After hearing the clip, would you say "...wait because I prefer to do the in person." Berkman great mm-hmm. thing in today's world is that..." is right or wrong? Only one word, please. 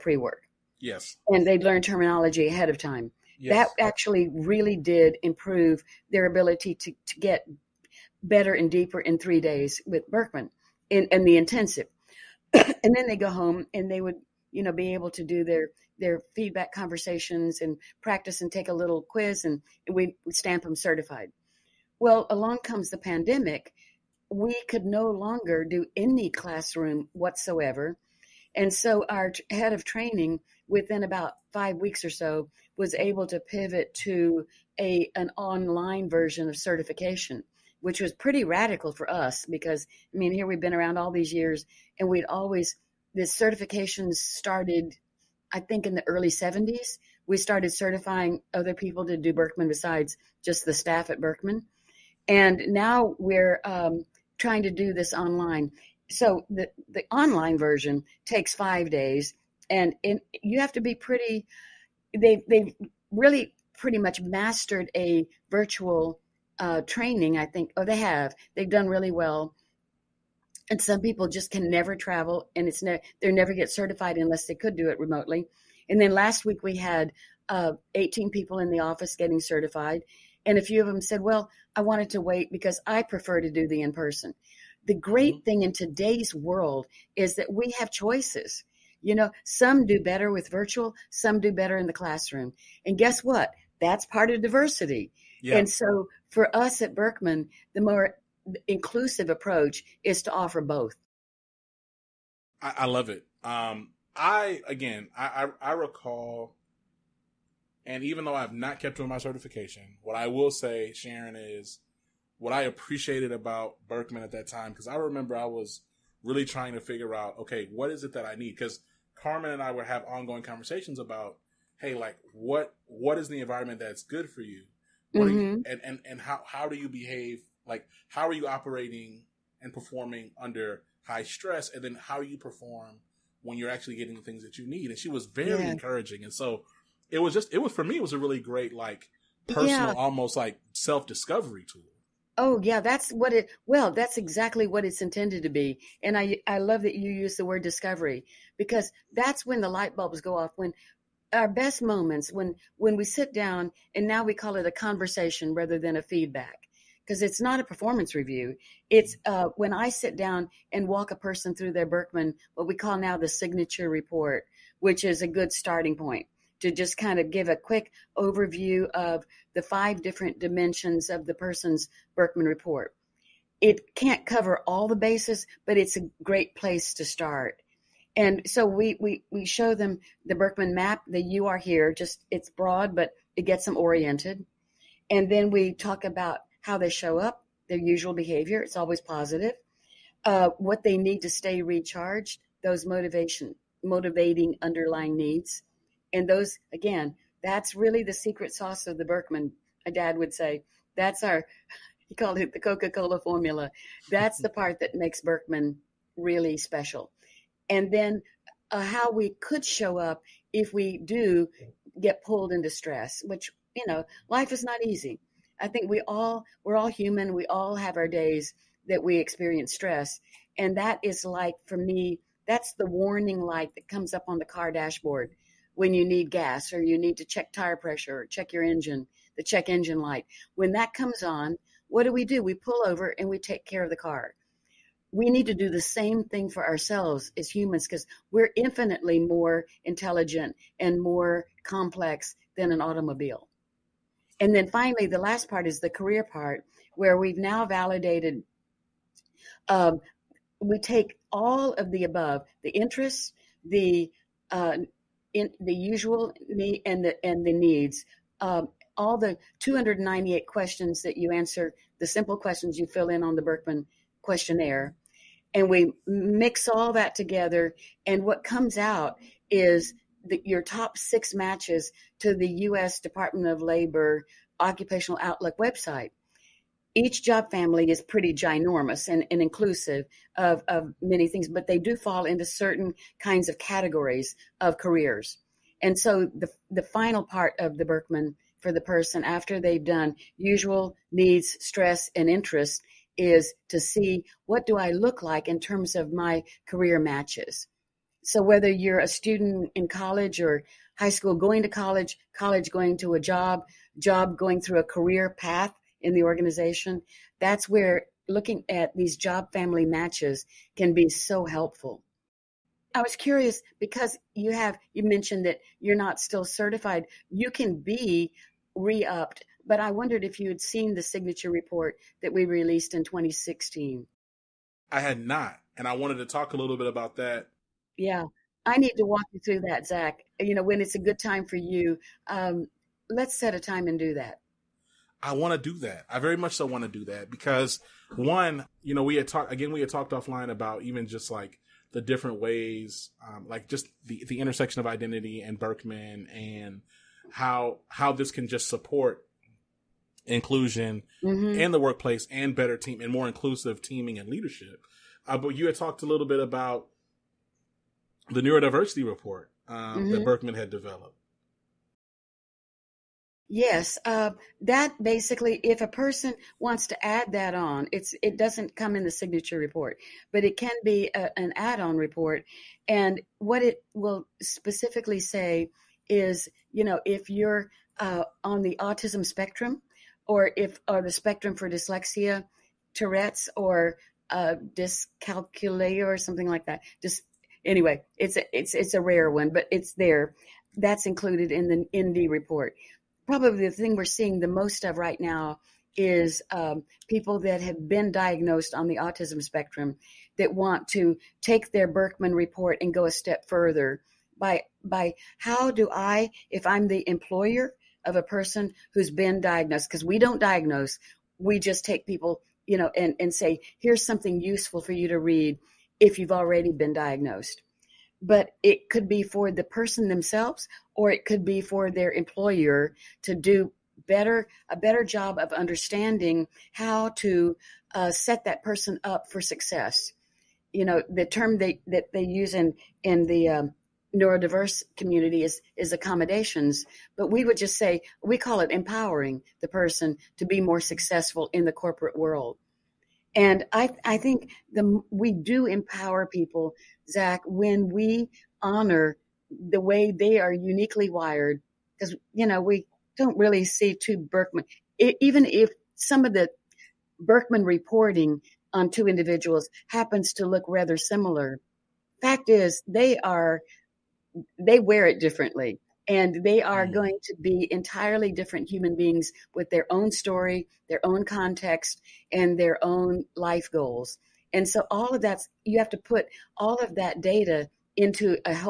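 wrong.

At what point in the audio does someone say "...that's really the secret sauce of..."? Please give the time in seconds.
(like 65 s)
197 s.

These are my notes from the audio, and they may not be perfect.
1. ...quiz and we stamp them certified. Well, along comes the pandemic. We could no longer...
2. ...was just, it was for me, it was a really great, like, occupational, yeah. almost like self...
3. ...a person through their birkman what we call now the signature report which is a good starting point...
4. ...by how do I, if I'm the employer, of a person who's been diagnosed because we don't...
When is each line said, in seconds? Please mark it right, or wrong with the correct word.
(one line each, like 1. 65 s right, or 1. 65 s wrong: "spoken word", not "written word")
1. 19 s right
2. 137 s wrong: "personal", not "occupational"
3. 161 s right
4. 404 s right.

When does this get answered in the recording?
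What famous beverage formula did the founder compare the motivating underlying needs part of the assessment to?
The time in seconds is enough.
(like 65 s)
202 s.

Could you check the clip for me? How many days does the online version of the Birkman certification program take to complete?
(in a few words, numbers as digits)
5.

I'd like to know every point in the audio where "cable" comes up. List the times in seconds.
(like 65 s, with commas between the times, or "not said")
not said.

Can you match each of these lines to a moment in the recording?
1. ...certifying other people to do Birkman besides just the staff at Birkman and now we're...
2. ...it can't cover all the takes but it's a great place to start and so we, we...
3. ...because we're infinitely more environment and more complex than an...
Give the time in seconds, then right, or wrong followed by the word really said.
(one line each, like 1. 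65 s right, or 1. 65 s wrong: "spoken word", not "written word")
1. 47 s right
2. 173 s wrong: "bases", not "takes"
3. 237 s wrong: "intelligent", not "environment".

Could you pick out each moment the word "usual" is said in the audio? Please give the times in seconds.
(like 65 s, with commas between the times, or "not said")
187 s, 255 s, 290 s.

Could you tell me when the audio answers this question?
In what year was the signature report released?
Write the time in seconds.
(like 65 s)
323 s.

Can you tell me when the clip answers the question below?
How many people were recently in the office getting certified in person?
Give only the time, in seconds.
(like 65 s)
77 s.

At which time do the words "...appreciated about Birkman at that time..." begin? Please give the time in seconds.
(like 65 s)
112 s.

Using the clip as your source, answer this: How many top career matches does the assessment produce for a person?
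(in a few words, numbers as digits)
6.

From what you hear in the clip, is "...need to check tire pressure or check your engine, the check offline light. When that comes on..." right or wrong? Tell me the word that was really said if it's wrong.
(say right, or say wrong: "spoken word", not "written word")
wrong: "engine", not "offline".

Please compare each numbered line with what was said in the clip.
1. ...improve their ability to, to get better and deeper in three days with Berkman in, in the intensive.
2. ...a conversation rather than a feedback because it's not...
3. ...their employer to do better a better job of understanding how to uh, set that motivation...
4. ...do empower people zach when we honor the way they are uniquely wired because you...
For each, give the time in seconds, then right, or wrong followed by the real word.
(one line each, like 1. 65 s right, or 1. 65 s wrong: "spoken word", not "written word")
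1. 5 s right
2. 154 s right
3. 421 s wrong: "person", not "motivation"
4. 445 s right.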